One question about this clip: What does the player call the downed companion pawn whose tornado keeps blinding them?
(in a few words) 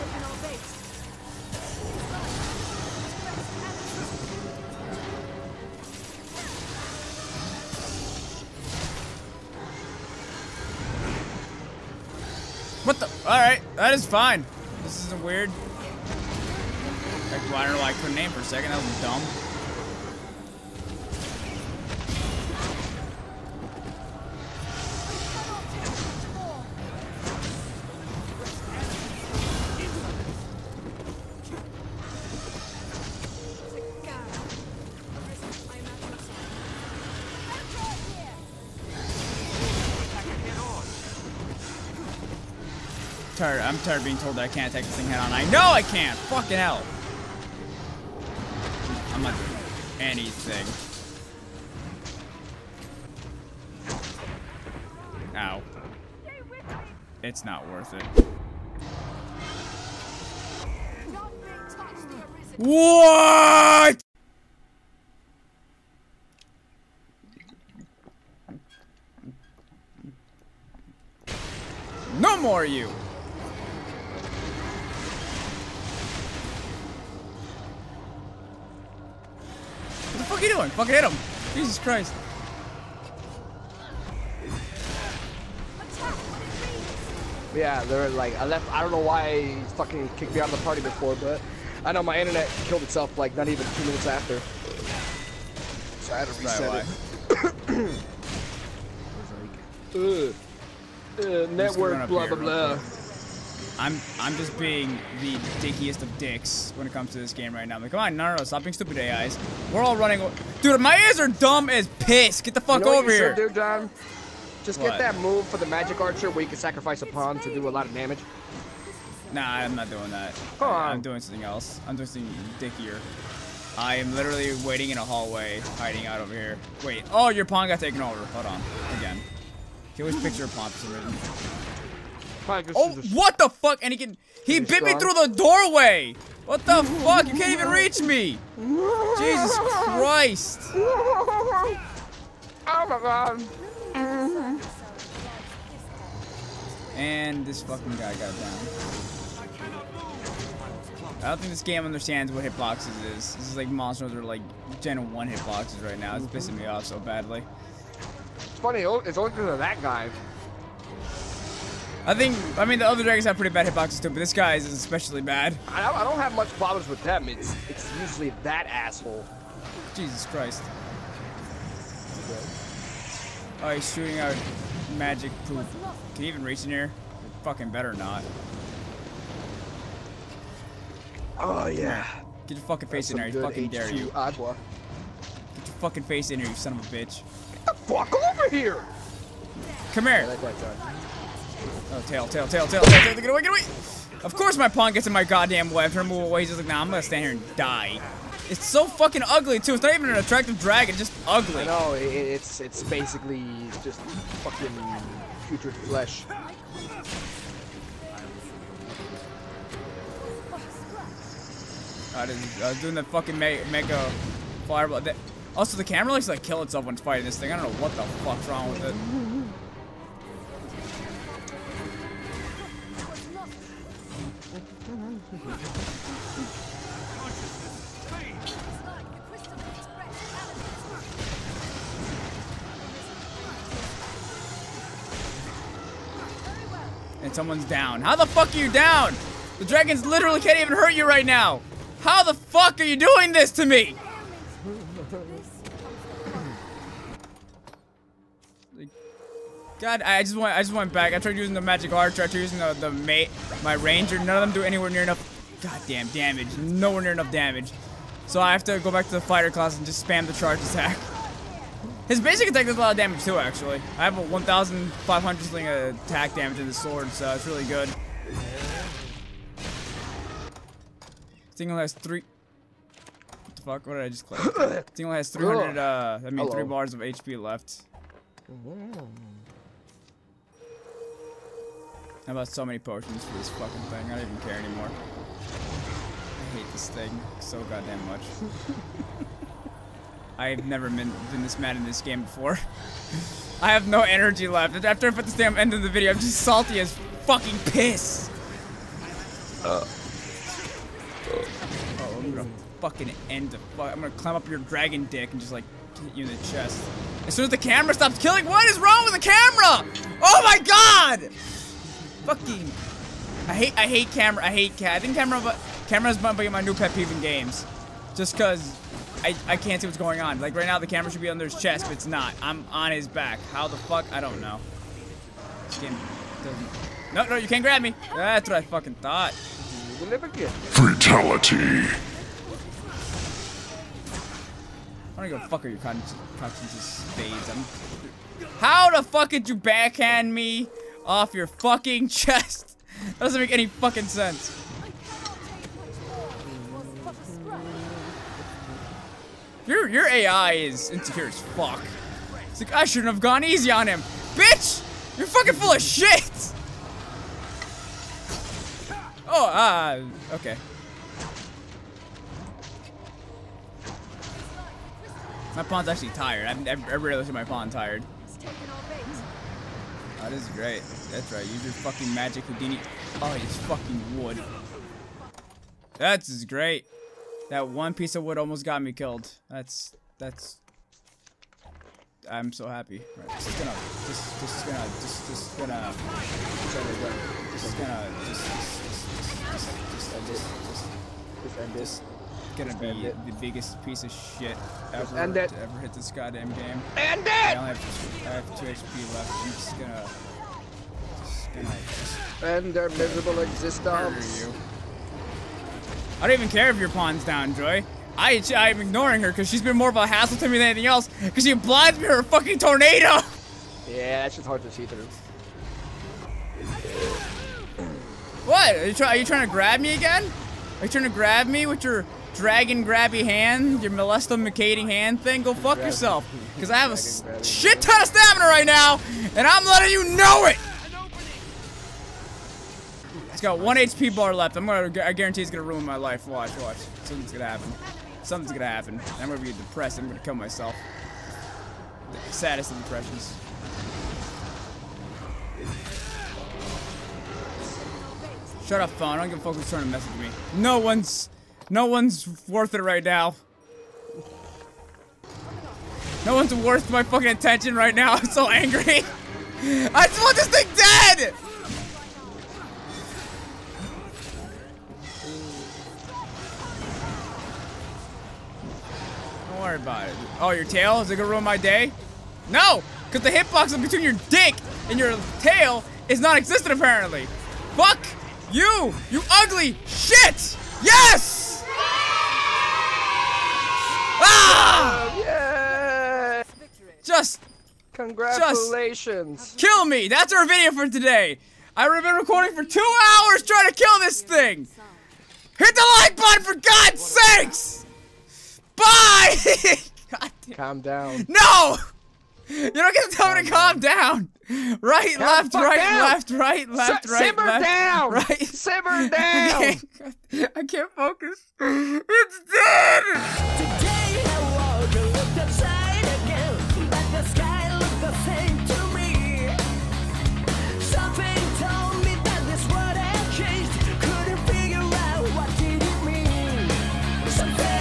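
Joy.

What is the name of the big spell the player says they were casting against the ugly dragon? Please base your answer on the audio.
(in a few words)
Mega fireball.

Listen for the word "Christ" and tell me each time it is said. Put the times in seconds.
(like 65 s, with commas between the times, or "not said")
81 s, 139 s, 170 s.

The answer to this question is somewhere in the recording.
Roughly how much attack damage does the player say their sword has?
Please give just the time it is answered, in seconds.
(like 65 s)
264 s.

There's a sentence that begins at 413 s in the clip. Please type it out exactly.
Yeah, that's just hard to see through.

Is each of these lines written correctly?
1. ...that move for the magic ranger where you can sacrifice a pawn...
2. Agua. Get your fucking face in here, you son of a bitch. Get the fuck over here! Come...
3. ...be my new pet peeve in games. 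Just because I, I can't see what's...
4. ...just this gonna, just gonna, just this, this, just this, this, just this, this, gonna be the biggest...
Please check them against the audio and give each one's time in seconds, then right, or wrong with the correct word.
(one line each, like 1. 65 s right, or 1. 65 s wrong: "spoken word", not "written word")
1. 114 s wrong: "archer", not "ranger"
2. 184 s right
3. 316 s right
4. 384 s right.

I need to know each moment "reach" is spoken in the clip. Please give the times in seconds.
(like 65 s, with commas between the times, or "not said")
137 s, 176 s.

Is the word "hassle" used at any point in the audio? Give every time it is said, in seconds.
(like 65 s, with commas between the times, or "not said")
410 s.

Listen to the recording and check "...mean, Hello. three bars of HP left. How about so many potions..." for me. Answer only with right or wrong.
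right.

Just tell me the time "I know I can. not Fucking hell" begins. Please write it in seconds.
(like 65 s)
45 s.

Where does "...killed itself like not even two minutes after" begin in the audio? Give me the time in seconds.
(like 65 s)
92 s.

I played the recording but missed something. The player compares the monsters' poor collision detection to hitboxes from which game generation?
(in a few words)
Gen 1.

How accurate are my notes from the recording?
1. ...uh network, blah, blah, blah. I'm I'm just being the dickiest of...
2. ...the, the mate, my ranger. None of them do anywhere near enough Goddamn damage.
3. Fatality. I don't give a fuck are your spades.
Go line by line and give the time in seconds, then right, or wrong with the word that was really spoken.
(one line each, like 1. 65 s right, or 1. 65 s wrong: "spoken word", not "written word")
1. 101 s right
2. 252 s right
3. 329 s right.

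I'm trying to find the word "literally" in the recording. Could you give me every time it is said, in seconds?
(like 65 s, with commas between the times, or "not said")
124 s, 240 s.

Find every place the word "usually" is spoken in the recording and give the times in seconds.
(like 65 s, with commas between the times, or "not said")
167 s.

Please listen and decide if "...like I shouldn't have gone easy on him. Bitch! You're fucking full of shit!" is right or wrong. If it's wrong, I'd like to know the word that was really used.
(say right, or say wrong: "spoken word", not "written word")
right.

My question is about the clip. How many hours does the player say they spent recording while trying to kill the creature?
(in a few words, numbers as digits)
2.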